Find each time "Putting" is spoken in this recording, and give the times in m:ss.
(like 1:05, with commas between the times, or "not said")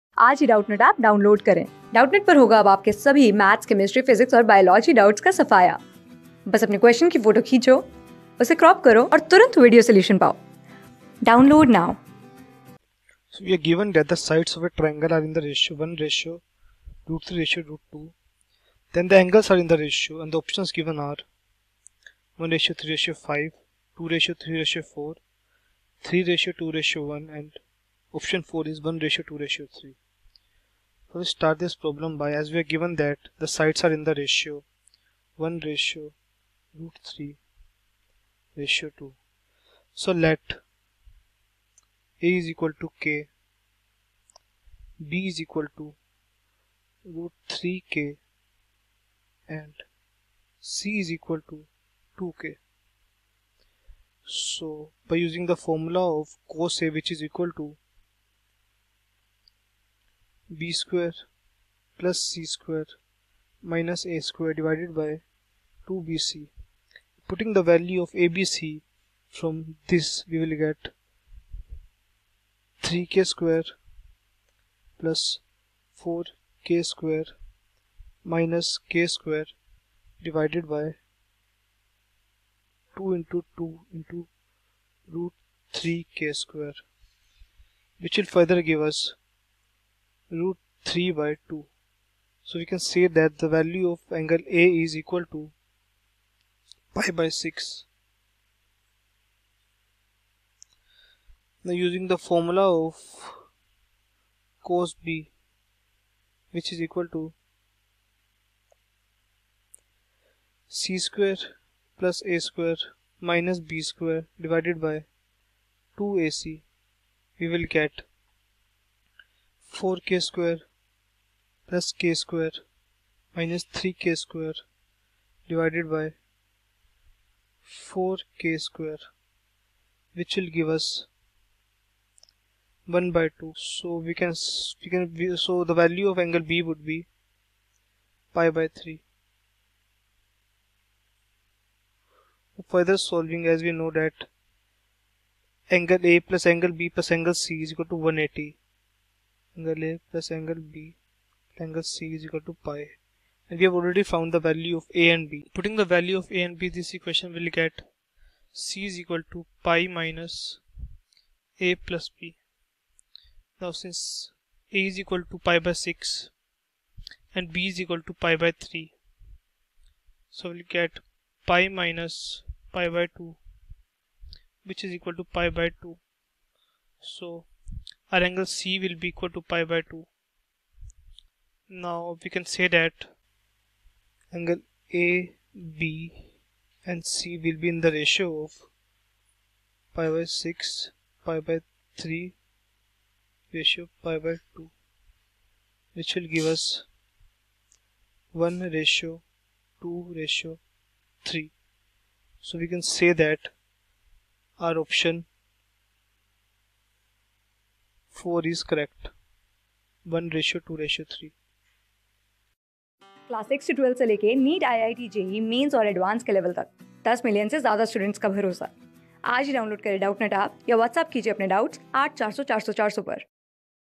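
1:07, 2:35.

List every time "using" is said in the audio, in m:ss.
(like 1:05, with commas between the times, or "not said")
0:55, 1:41.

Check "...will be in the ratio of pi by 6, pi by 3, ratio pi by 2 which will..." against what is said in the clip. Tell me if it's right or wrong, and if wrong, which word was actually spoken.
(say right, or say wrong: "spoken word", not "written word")
right.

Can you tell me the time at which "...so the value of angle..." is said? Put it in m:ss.
2:15.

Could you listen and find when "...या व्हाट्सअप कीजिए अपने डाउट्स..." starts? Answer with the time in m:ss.
3:40.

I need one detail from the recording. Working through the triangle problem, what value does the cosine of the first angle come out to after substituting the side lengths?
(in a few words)
√3/2.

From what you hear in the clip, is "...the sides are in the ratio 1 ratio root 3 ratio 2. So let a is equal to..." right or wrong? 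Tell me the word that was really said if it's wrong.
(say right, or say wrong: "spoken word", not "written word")
right.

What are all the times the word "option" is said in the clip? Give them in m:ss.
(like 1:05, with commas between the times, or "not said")
0:20, 0:28, 3:24.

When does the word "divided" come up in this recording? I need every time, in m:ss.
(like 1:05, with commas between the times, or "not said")
1:04, 1:20, 1:54, 2:05.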